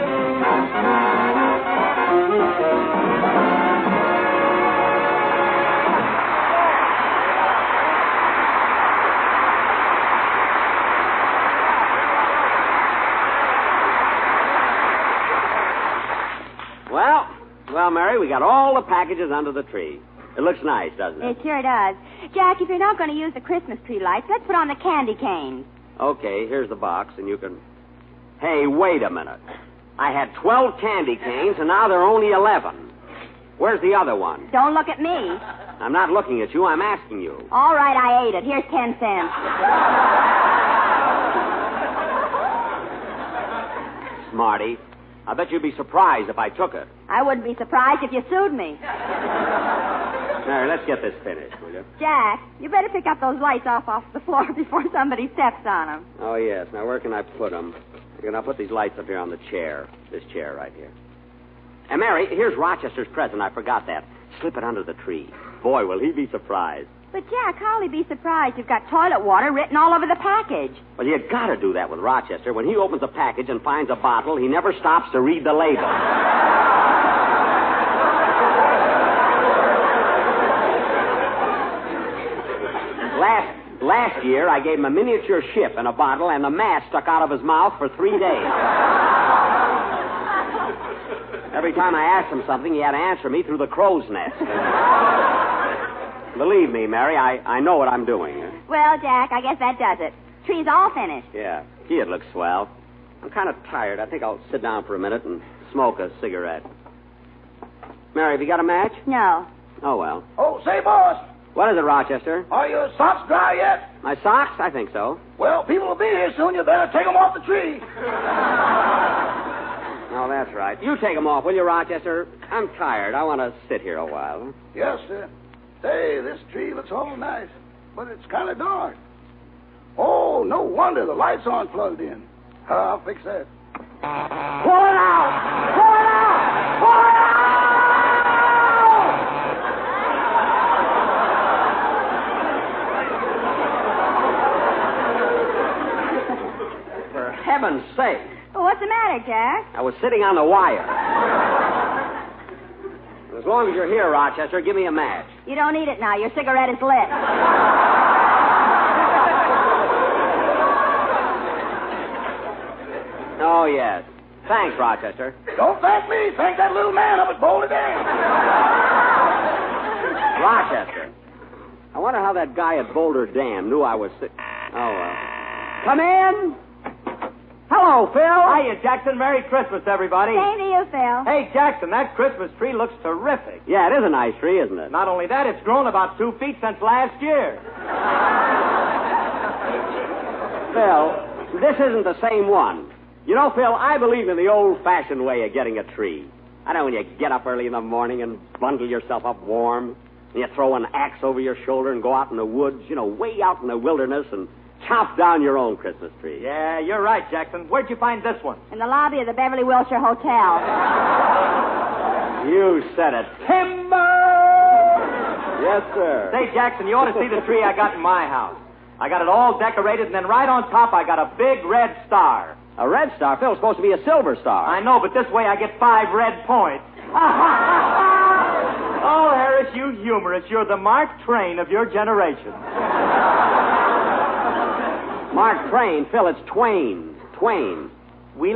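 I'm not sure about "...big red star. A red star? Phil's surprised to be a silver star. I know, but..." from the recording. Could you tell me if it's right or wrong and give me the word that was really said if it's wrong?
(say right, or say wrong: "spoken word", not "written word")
wrong: "supposed", not "surprised".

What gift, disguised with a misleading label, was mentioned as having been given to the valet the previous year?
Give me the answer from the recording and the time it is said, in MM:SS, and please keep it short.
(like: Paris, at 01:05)
a miniature ship, at 01:24.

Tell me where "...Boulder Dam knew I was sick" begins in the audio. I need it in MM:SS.
02:52.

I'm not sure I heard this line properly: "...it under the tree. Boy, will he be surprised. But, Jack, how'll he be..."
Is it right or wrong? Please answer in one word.
right.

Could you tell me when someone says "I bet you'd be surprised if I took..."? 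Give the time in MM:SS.
00:45.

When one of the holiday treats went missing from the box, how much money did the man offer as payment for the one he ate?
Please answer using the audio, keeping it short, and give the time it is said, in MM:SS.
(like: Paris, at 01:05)
10 cents, at 00:38.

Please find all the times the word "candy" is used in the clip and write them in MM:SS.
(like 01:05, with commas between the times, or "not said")
00:24, 00:30.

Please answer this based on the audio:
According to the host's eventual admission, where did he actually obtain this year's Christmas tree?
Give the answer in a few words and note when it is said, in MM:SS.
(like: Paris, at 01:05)
Beverly Wilshire Hotel, at 03:29.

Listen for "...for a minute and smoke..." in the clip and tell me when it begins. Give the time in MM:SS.
01:44.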